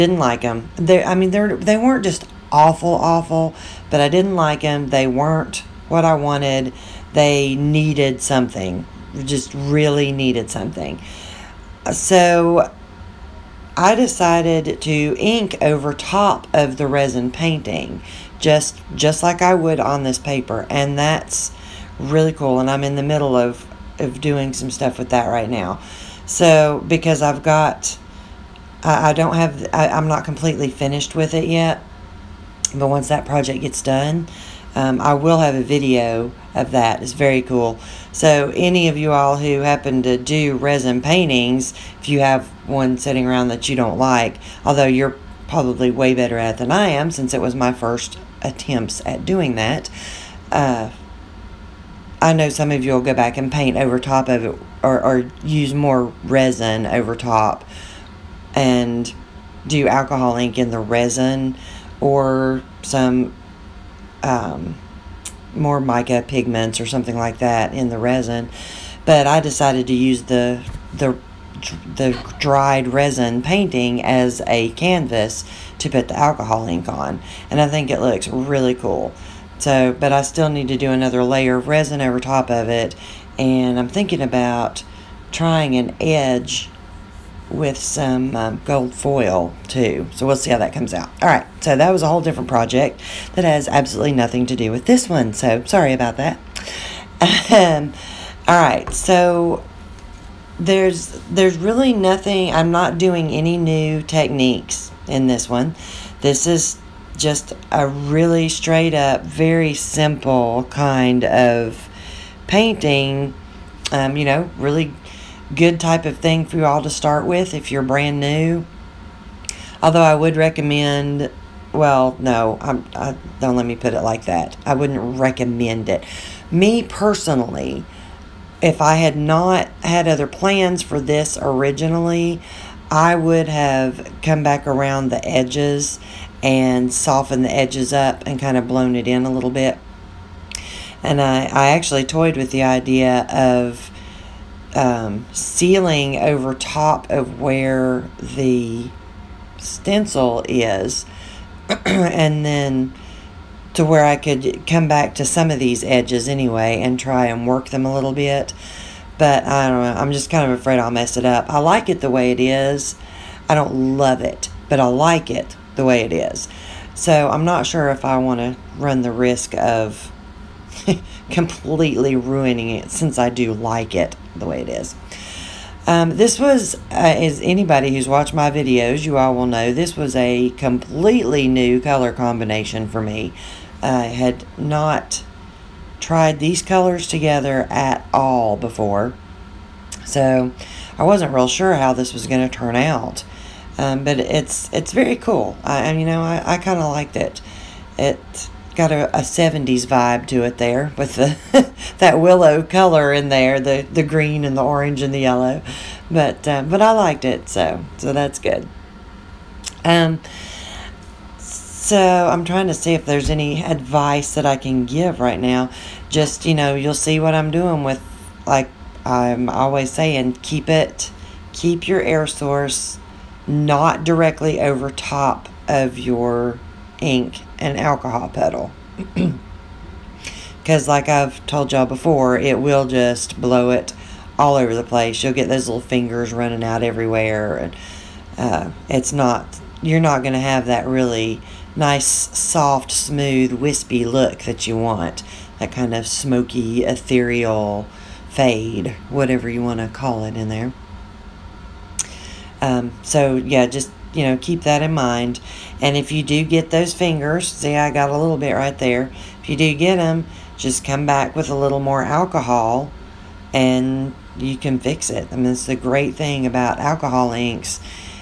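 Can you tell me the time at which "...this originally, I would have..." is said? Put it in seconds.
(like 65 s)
131 s.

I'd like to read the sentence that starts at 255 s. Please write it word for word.
And if you do get those fingers, see I got a little bit right there.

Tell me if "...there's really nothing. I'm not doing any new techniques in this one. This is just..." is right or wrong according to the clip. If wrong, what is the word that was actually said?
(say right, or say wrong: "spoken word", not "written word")
right.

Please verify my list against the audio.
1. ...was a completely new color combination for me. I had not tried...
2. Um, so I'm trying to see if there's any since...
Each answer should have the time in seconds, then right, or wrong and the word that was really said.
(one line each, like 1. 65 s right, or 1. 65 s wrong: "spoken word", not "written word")
1. 179 s right
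2. 209 s wrong: "advice", not "since".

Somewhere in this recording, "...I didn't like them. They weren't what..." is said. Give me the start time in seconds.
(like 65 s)
4 s.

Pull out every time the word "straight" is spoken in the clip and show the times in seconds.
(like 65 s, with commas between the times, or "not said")
108 s.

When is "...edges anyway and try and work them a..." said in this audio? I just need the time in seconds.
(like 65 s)
155 s.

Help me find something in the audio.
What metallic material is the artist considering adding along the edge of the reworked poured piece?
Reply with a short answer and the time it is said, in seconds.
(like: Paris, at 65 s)
gold foil, at 88 s.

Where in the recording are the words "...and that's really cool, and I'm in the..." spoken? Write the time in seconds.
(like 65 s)
20 s.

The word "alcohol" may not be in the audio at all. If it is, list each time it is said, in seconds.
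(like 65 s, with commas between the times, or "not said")
59 s, 76 s, 227 s, 262 s, 266 s.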